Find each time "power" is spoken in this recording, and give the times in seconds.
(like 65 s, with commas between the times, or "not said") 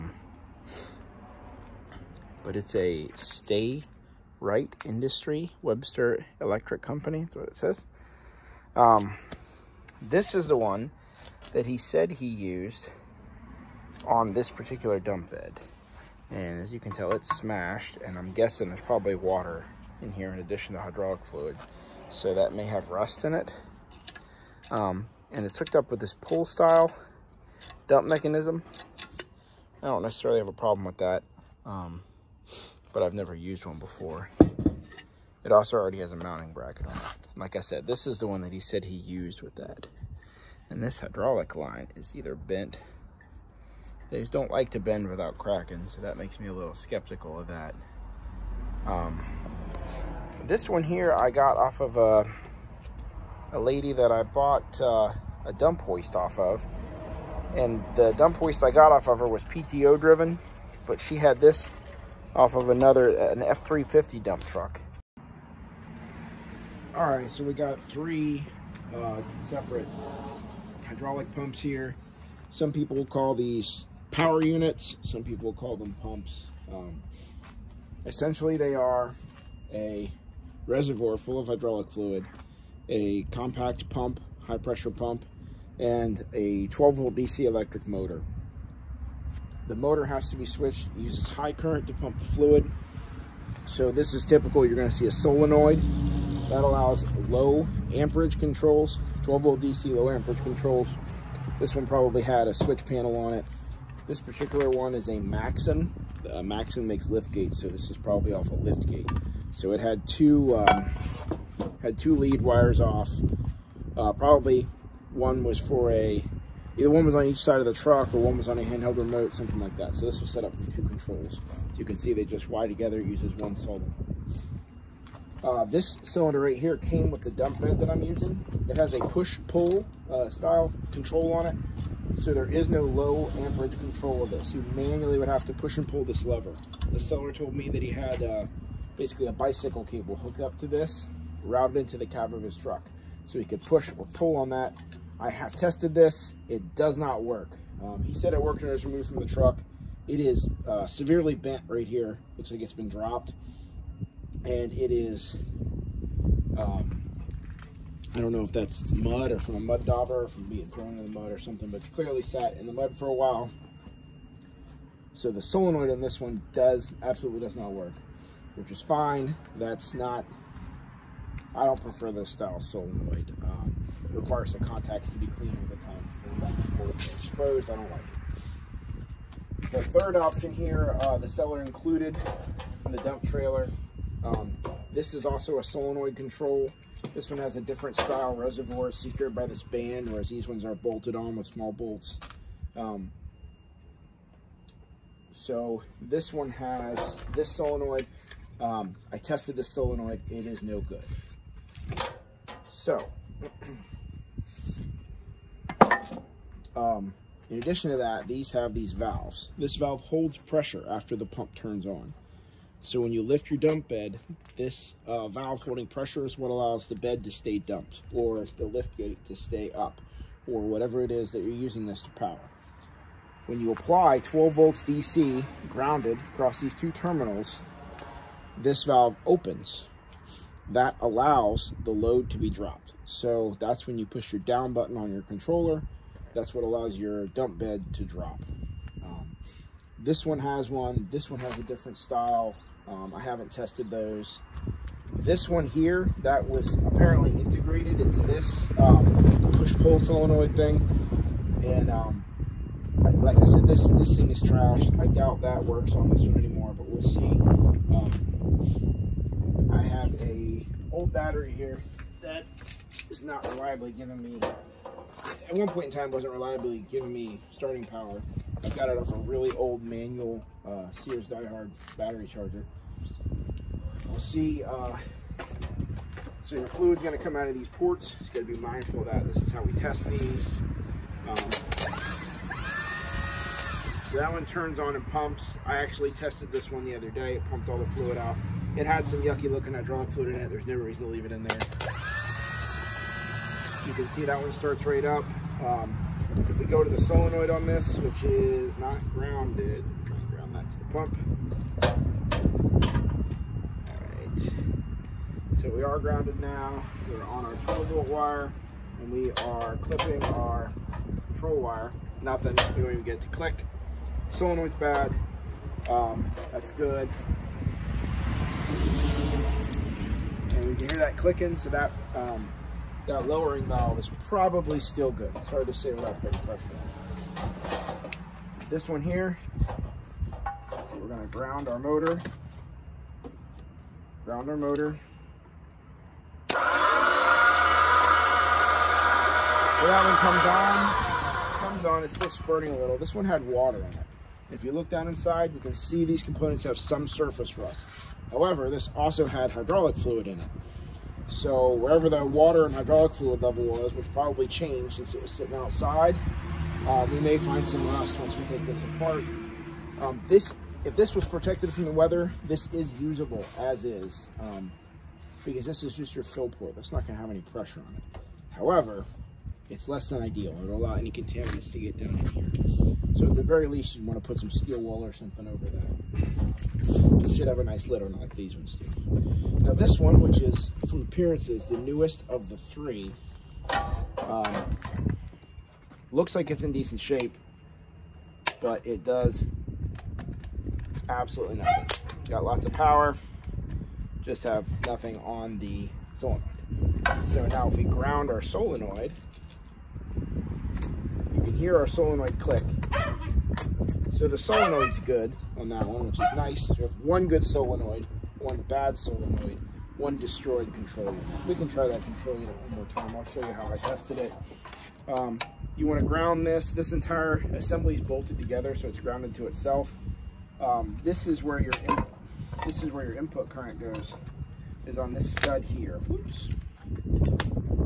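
74 s, 222 s, 267 s, 392 s.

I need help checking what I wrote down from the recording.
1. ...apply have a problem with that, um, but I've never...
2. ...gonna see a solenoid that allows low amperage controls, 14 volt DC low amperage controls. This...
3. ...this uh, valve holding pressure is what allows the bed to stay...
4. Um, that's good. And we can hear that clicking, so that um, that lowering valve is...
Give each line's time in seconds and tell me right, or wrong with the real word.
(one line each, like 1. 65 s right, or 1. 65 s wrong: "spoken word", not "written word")
1. 30 s wrong: "necessarily", not "apply"
2. 94 s wrong: "12", not "14"
3. 214 s right
4. 315 s right.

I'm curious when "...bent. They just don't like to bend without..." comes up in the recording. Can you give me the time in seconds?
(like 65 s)
42 s.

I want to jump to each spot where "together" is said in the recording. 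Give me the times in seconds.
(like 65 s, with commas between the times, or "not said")
122 s, 418 s.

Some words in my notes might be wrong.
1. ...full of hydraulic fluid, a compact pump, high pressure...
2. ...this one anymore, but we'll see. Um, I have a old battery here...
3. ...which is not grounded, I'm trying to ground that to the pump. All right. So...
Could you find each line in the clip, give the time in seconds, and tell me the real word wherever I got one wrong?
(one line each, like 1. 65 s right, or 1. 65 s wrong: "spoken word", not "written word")
1. 81 s right
2. 256 s right
3. 297 s right.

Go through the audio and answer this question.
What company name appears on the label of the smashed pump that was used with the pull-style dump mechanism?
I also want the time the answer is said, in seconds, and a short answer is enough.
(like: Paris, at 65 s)
Webster Electric Company, at 5 s.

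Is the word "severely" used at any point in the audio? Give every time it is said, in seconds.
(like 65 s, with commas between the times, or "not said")
150 s.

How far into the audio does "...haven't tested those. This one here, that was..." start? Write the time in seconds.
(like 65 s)
243 s.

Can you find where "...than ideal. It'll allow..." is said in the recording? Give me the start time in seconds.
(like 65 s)
370 s.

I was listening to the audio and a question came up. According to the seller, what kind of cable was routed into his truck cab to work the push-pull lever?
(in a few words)
Bicycle cable.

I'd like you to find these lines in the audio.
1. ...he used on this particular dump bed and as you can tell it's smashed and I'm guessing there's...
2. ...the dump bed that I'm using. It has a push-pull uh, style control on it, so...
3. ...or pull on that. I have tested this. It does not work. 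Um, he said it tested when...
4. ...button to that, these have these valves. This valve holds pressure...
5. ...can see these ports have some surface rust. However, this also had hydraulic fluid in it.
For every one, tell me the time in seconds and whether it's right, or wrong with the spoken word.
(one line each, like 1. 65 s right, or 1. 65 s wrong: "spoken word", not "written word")
1. 12 s right
2. 127 s right
3. 143 s wrong: "worked", not "tested"
4. 207 s wrong: "addition", not "button"
5. 345 s wrong: "components", not "ports".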